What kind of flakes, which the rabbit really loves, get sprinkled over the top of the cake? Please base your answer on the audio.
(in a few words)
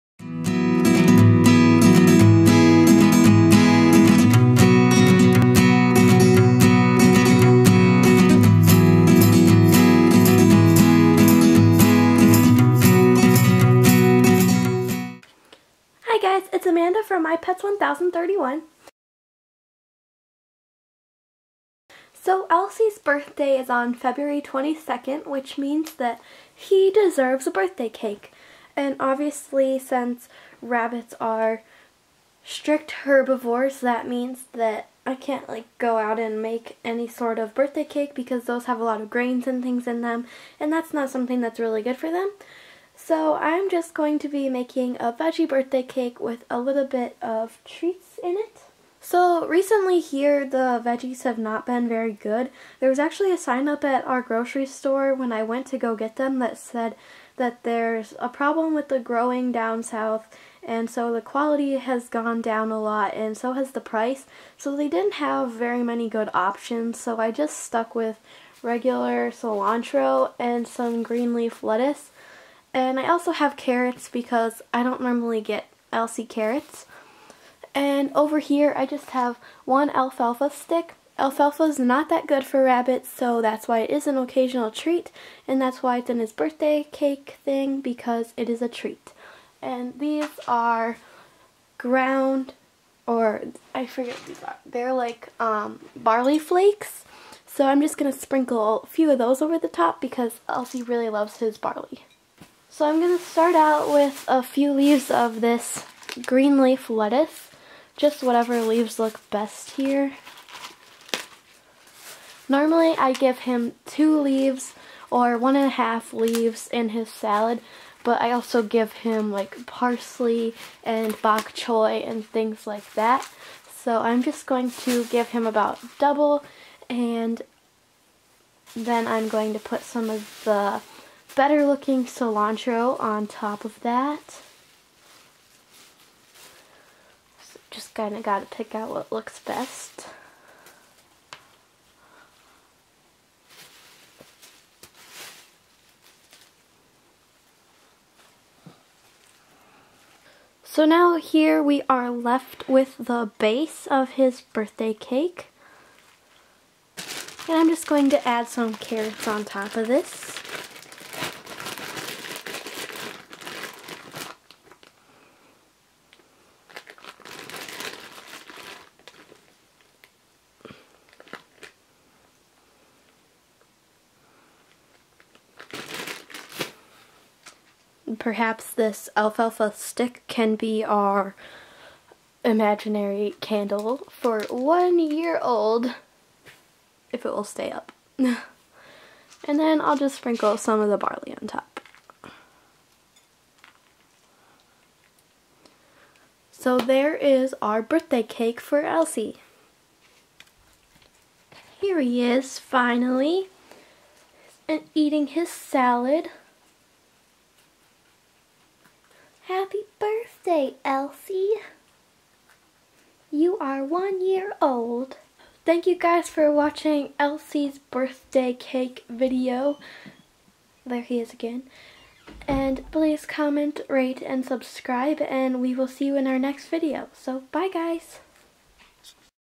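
Barley flakes.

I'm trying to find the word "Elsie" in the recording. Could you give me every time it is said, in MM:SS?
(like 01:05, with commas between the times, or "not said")
00:22, 01:15, 01:40, 03:18, 03:30, 03:37.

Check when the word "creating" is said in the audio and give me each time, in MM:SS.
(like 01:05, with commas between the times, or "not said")
not said.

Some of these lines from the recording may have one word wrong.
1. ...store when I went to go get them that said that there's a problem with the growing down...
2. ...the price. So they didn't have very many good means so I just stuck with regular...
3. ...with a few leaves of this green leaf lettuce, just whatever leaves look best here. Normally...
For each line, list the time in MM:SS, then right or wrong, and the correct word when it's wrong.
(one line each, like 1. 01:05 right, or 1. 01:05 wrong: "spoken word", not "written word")
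1. 00:54 right
2. 01:03 wrong: "options", not "means"
3. 01:43 right.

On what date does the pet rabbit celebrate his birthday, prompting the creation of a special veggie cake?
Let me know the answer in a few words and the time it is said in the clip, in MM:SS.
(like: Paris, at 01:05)
February 22, at 00:23.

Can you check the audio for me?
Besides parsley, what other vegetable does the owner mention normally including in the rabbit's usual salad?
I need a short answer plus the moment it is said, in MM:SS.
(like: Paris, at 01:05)
Bok choy, at 02:01.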